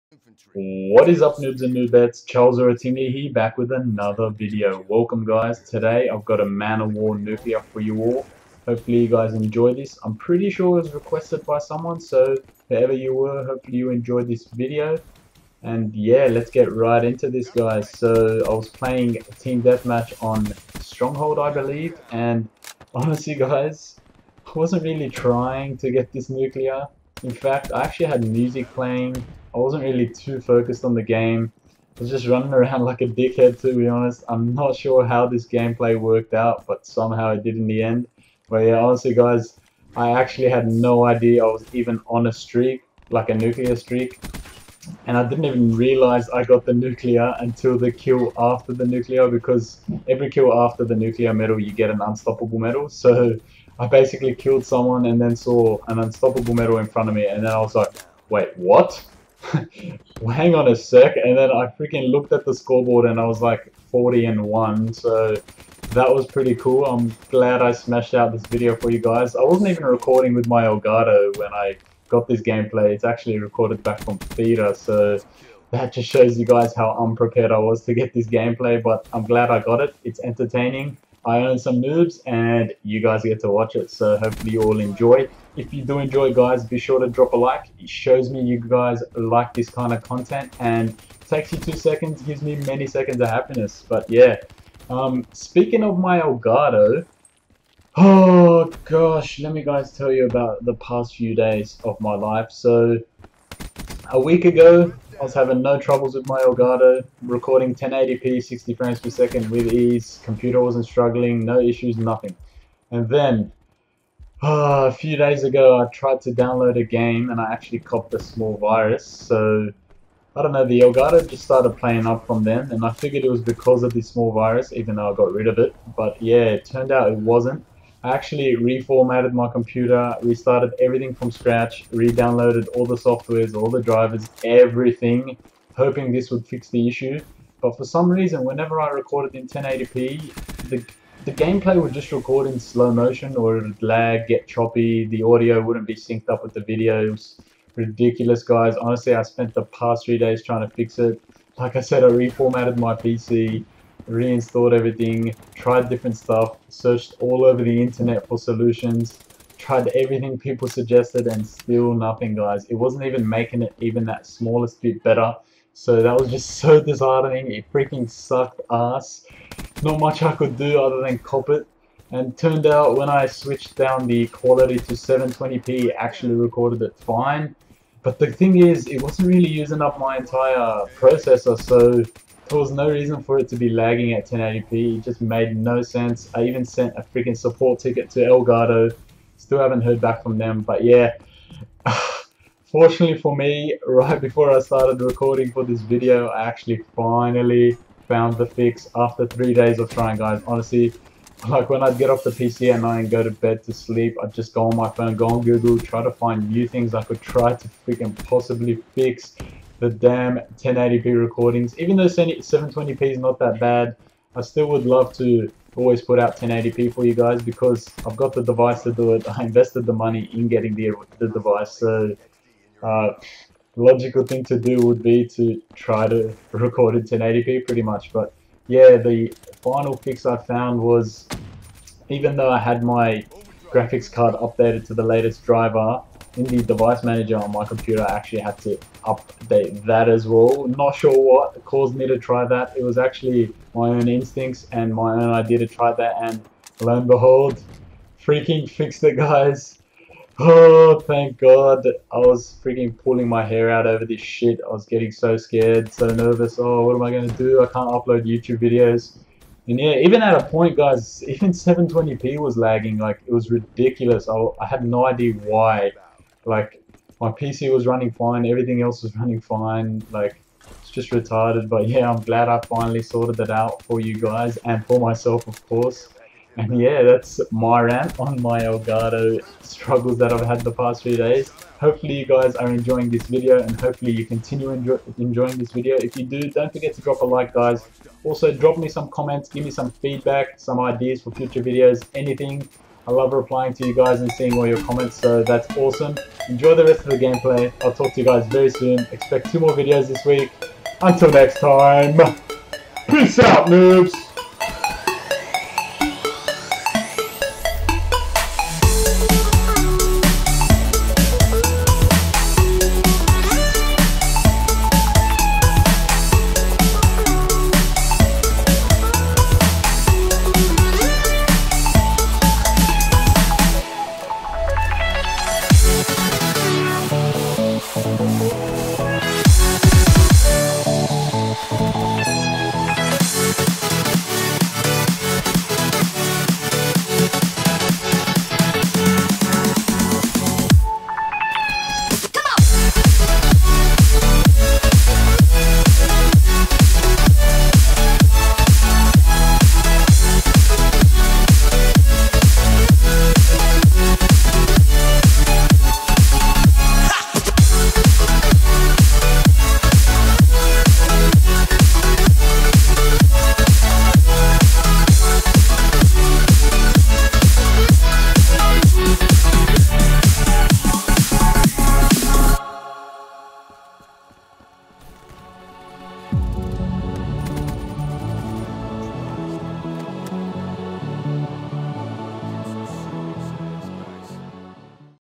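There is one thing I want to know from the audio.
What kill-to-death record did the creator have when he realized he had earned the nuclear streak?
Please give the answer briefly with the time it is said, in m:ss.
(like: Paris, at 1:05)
40 and 1, at 1:03.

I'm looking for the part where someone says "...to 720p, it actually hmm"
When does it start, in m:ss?
2:54.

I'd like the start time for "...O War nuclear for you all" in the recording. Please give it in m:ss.
0:06.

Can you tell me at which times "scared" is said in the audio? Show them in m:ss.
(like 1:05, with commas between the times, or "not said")
4:15.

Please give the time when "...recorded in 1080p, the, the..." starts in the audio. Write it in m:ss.
2:18.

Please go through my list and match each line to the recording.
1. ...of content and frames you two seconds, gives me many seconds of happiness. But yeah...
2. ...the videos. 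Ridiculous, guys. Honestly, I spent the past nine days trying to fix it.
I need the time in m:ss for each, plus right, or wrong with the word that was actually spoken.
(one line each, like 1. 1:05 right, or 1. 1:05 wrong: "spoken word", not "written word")
1. 1:29 wrong: "takes", not "frames"
2. 2:26 wrong: "three", not "nine".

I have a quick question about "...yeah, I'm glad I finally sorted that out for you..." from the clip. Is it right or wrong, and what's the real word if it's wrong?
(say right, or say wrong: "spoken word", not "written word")
right.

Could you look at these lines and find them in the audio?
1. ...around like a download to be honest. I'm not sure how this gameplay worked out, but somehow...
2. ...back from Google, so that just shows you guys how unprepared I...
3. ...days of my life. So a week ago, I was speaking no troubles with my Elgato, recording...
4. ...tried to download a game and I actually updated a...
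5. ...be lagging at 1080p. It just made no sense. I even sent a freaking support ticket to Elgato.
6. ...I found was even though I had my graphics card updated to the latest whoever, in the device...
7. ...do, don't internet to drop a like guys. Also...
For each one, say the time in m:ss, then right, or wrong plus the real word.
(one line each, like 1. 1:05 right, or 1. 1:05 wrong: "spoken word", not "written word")
1. 0:32 wrong: "dickhead", not "download"
2. 1:13 wrong: "Theater", not "Google"
3. 1:41 wrong: "having", not "speaking"
4. 1:55 wrong: "copped", not "updated"
5. 3:03 right
6. 3:50 wrong: "driver", not "whoever"
7. 4:46 wrong: "forget", not "internet".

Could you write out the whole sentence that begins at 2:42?
It wasn't even making it even that smallest bit better.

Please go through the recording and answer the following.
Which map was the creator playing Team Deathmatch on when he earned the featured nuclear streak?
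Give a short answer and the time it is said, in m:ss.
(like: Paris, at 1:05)
Stronghold, at 0:20.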